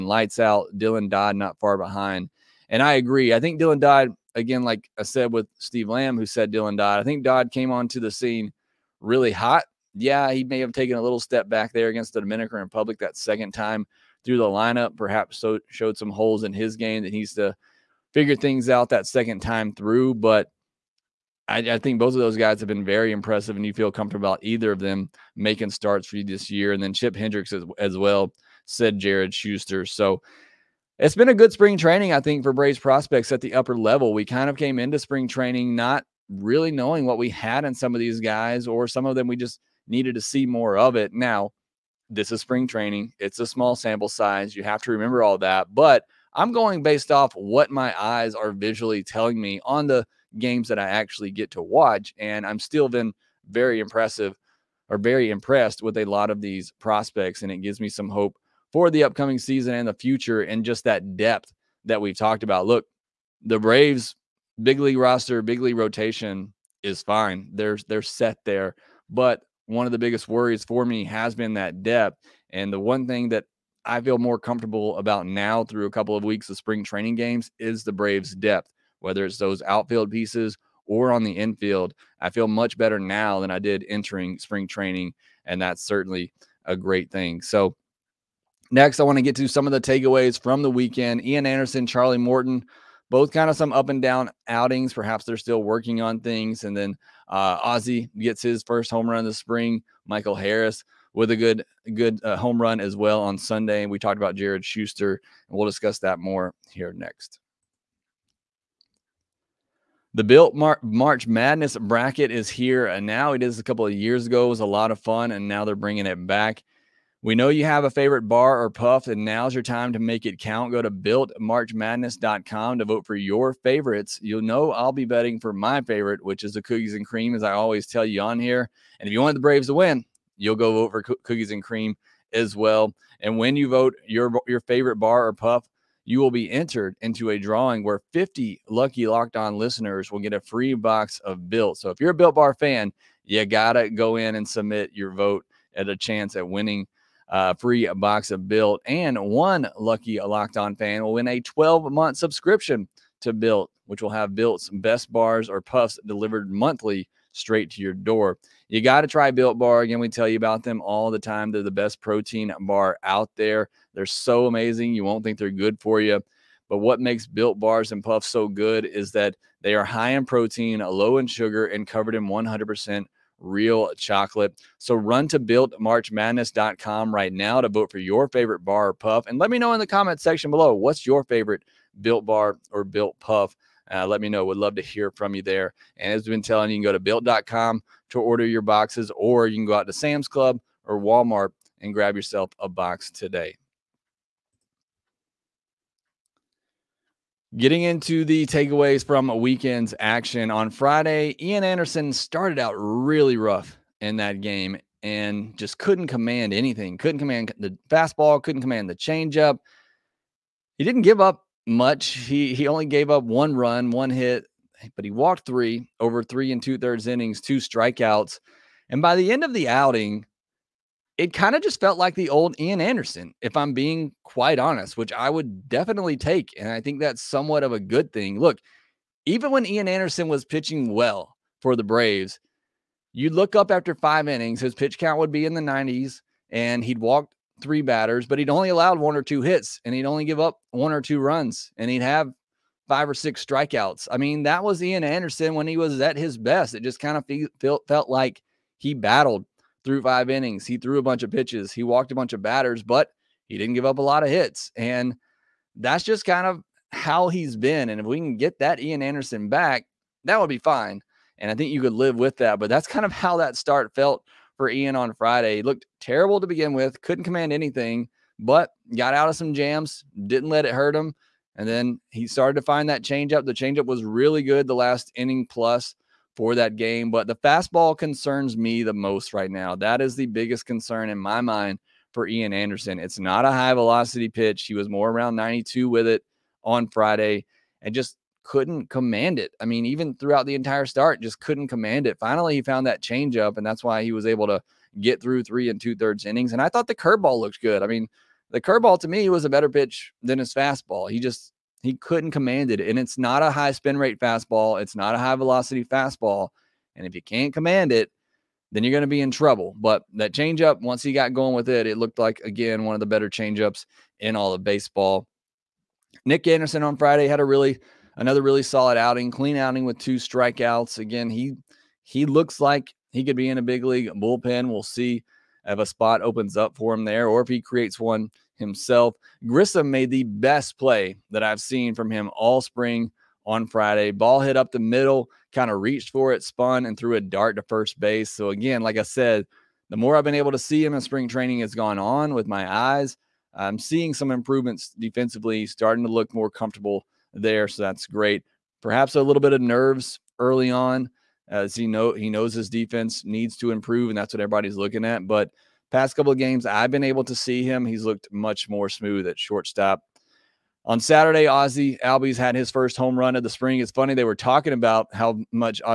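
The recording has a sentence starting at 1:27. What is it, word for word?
So, next, I want to get to some of the takeaways from the weekend.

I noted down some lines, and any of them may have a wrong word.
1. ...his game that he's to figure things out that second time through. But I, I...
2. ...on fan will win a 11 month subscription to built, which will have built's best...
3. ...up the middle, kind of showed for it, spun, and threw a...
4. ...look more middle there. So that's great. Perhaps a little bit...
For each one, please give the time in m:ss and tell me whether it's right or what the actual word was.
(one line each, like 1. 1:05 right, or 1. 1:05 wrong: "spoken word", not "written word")
1. 0:16 right
2. 2:30 wrong: "12", not "11"
3. 5:34 wrong: "reached", not "showed"
4. 5:46 wrong: "comfortable", not "middle".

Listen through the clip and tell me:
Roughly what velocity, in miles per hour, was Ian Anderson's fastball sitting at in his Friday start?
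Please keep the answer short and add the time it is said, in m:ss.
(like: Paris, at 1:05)
92, at 4:45.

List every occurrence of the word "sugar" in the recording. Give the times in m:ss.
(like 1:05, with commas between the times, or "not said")
2:51.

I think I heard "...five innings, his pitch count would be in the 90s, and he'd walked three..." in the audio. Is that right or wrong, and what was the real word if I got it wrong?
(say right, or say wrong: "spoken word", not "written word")
right.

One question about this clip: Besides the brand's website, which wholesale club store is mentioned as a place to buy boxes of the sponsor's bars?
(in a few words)
Sam's Club.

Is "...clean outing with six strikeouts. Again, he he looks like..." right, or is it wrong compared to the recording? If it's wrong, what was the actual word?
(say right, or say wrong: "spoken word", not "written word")
wrong: "two", not "six".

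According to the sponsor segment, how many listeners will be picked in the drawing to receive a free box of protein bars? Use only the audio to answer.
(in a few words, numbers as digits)
50.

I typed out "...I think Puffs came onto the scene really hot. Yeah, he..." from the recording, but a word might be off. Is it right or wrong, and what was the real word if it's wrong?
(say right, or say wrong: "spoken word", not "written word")
wrong: "Dodd", not "Puffs".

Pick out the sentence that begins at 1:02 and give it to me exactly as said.
Look, the Braves big league roster, big league rotation is fine.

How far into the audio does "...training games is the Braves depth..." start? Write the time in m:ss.
1:16.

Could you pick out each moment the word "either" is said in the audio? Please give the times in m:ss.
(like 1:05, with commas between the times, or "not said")
0:24.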